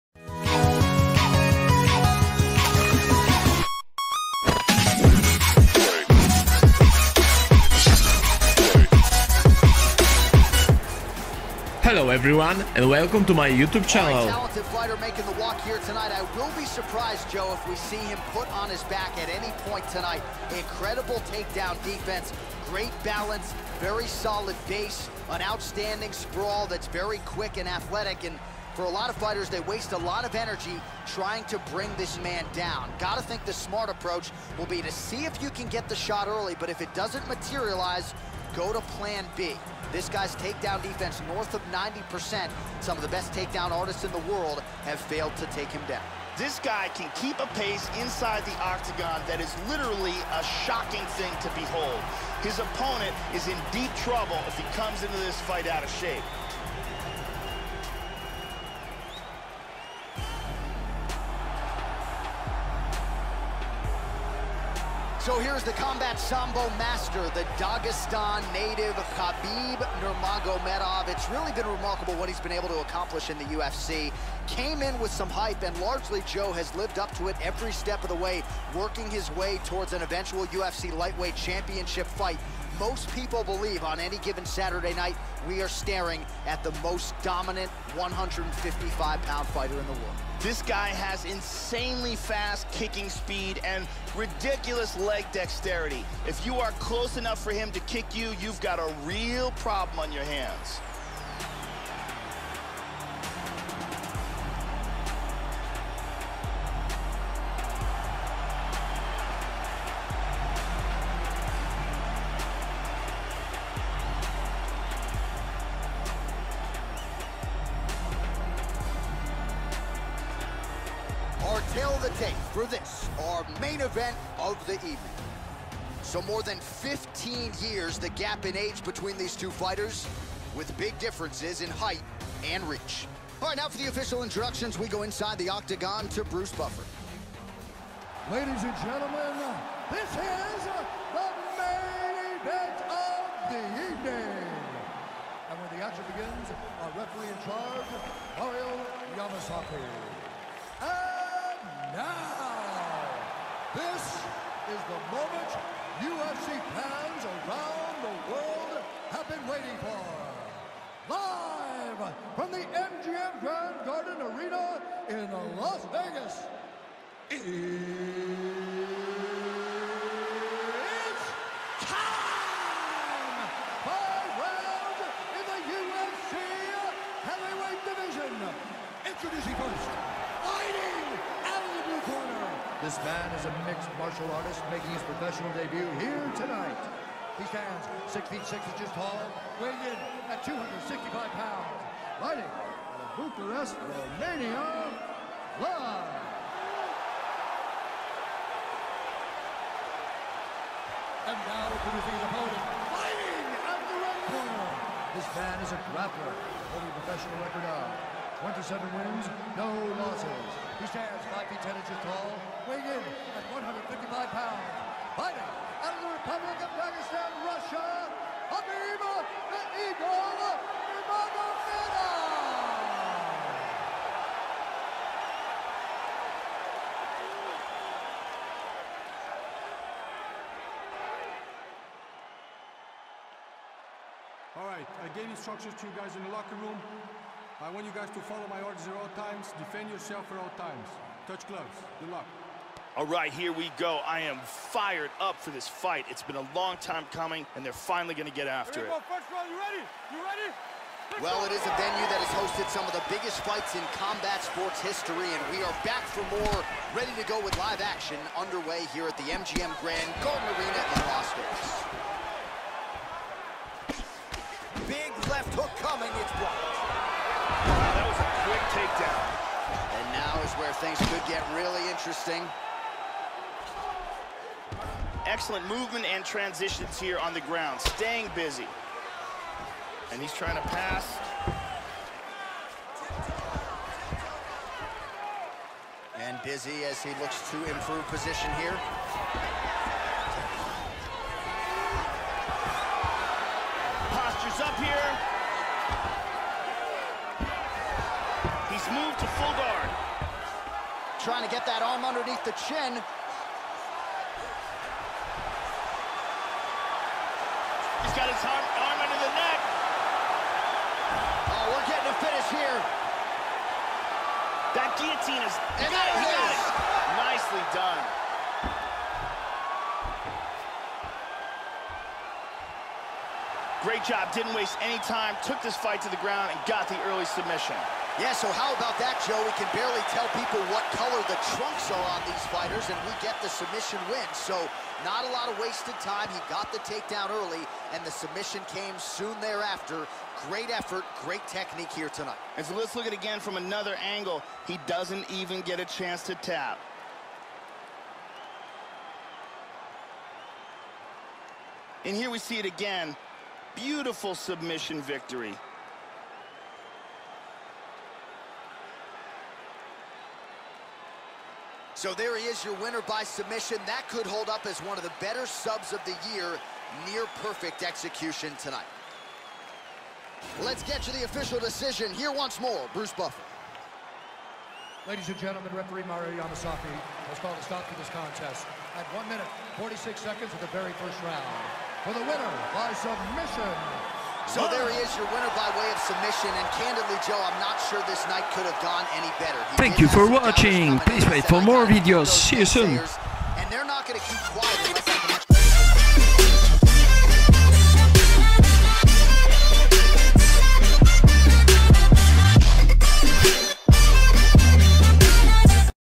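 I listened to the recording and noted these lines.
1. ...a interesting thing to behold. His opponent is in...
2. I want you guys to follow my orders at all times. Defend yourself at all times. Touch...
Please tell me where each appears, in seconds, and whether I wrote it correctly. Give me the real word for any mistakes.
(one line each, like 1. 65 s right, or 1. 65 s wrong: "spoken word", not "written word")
1. 50 s wrong: "shocking", not "interesting"
2. 237 s right.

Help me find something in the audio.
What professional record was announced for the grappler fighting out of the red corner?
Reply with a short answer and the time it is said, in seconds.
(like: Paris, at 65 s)
27 wins, no losses, at 208 s.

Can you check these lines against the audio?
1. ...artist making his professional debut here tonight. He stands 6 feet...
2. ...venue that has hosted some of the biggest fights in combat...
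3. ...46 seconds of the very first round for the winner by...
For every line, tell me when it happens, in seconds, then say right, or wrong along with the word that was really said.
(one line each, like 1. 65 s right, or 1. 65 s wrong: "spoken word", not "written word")
1. 184 s right
2. 251 s right
3. 379 s right.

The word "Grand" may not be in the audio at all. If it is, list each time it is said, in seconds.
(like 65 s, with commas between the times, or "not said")
163 s, 259 s.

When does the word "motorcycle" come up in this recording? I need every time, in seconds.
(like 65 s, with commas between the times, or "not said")
not said.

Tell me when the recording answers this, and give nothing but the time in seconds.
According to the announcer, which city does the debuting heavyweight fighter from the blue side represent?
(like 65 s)
193 s.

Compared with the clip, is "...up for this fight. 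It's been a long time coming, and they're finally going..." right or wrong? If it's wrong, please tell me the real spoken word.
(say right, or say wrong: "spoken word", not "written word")
right.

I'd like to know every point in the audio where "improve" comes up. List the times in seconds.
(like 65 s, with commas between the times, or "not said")
287 s.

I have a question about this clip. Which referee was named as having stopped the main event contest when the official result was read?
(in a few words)
Mario Yamasaki.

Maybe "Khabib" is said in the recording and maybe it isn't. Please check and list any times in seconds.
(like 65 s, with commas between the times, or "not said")
69 s, 218 s.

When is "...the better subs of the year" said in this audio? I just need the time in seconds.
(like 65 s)
365 s.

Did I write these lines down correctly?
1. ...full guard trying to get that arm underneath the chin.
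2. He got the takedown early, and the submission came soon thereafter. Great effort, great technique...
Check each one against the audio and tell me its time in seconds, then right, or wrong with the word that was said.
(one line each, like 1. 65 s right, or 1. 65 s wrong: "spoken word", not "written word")
1. 299 s right
2. 336 s right.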